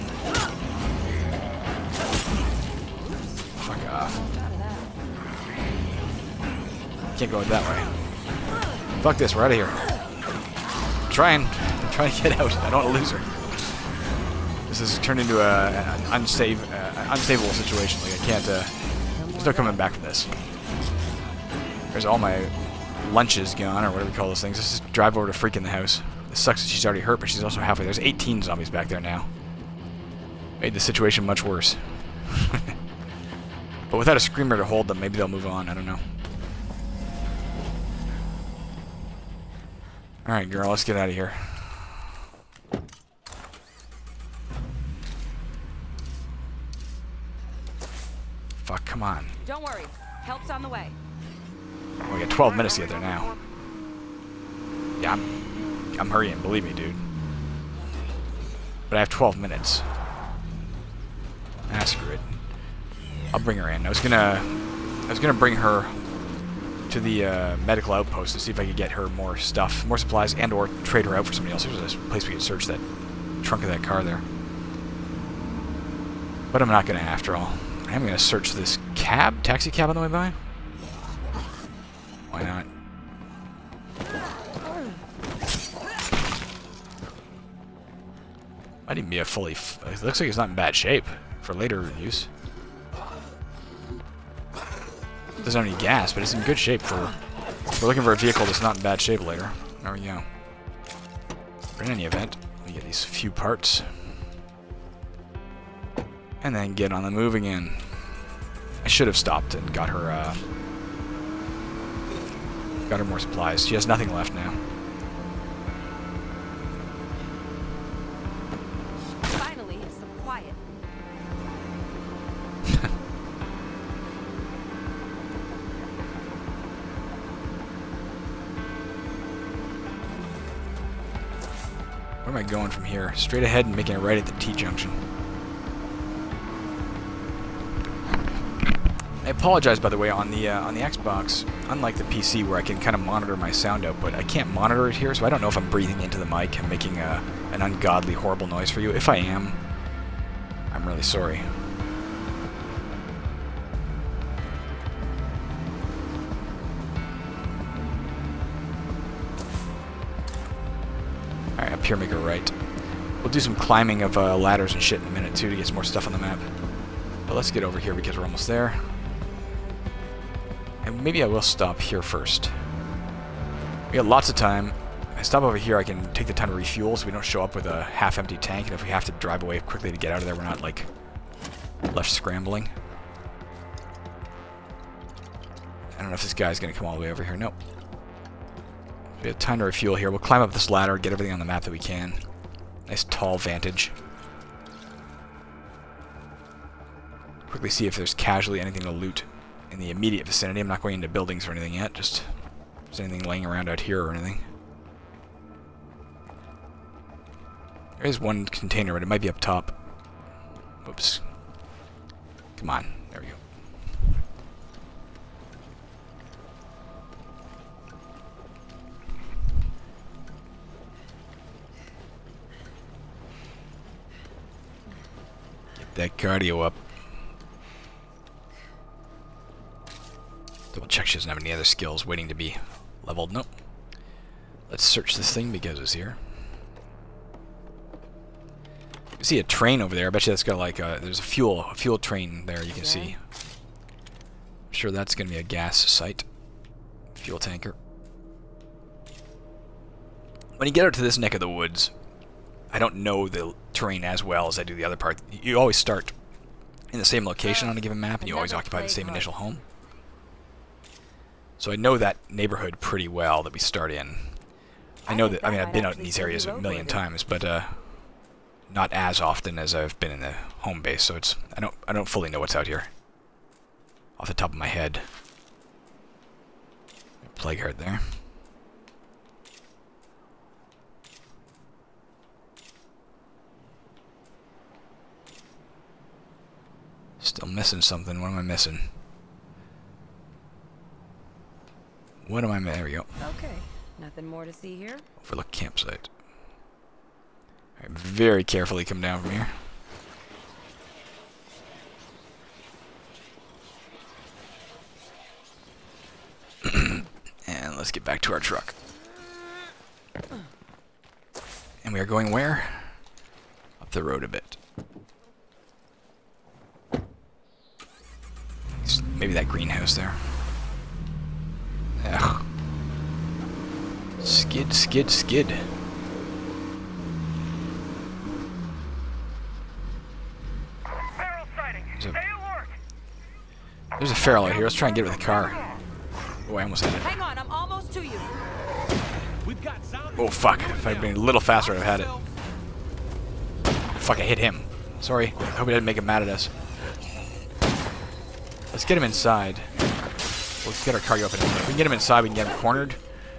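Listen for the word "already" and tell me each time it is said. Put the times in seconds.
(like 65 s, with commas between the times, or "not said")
26 s.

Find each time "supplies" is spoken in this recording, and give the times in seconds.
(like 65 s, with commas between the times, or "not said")
69 s, 113 s.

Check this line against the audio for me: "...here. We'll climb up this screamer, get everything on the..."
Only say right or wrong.
wrong.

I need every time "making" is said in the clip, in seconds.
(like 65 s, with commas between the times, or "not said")
133 s, 146 s.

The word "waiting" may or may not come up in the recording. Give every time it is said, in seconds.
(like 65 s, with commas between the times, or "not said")
232 s.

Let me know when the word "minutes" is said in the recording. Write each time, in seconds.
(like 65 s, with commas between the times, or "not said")
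52 s, 59 s, 165 s.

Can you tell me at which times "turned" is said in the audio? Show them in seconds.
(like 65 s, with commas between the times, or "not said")
14 s.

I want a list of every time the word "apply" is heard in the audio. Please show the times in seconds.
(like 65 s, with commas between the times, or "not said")
not said.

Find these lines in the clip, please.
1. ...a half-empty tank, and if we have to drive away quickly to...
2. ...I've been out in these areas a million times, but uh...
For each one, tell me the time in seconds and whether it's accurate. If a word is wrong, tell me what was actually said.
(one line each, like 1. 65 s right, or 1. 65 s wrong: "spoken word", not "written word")
1. 177 s right
2. 265 s right.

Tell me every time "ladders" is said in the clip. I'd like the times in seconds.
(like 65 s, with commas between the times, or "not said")
164 s, 190 s.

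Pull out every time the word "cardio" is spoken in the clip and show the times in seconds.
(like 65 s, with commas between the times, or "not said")
226 s.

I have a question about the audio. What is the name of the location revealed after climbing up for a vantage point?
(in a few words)
Overlook campsite.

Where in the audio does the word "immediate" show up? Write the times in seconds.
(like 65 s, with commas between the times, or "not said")
199 s.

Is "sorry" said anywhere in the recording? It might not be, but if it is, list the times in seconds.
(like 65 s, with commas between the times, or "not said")
151 s, 344 s.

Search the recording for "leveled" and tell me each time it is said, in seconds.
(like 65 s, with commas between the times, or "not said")
233 s.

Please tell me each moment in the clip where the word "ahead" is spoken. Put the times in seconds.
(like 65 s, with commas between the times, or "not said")
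133 s.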